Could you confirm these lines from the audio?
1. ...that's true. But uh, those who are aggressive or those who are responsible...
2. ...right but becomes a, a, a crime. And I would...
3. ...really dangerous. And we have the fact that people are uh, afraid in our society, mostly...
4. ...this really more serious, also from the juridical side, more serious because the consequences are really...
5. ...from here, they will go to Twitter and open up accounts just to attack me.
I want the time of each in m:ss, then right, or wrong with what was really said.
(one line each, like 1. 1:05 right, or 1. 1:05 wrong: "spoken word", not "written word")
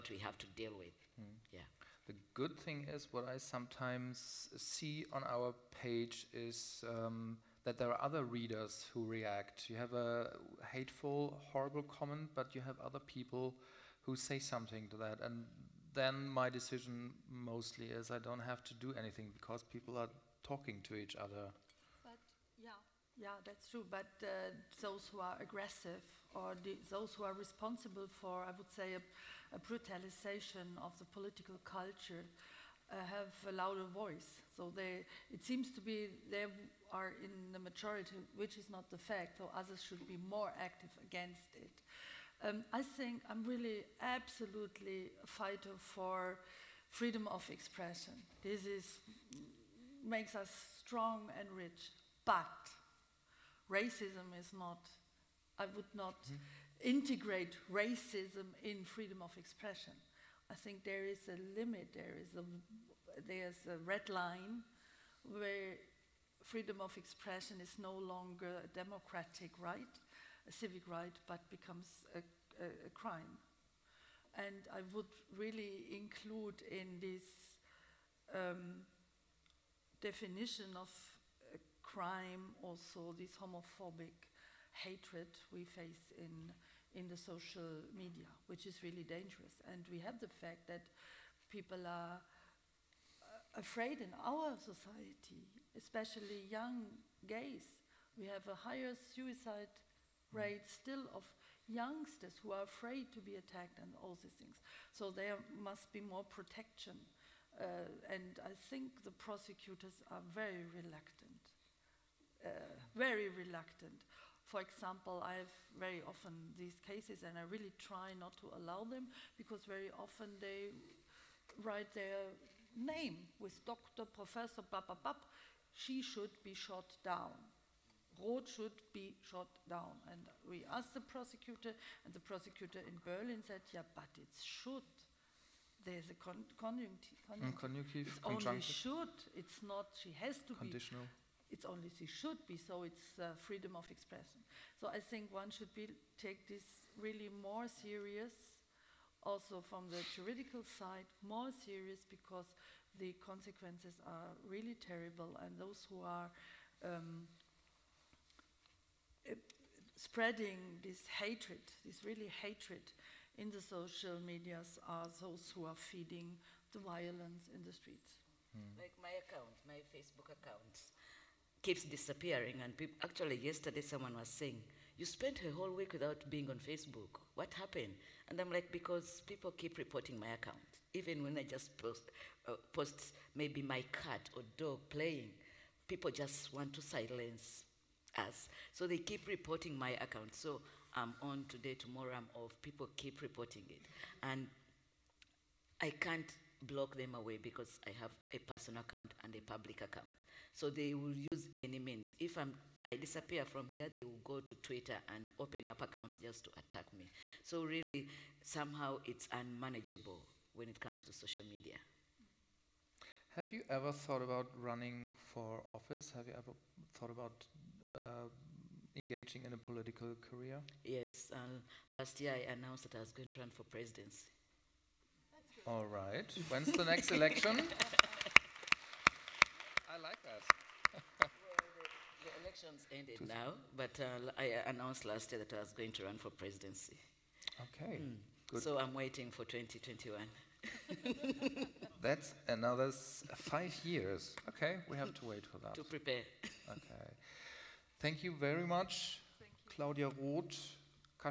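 1. 0:23 right
2. 1:10 right
3. 1:28 wrong: "especially", not "mostly"
4. 2:26 right
5. 3:23 right.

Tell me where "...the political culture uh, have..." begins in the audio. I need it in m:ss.
0:30.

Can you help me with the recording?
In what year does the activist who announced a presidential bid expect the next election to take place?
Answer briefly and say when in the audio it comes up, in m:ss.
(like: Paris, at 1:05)
2021, at 3:59.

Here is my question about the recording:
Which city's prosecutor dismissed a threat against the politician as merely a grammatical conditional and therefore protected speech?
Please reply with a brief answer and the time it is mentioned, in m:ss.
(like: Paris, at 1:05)
Berlin, at 2:13.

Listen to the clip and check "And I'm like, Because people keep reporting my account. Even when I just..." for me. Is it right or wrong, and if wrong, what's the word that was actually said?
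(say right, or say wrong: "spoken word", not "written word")
right.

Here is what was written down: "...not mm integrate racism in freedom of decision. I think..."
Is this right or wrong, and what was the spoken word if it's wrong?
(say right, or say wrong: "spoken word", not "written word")
wrong: "expression", not "decision".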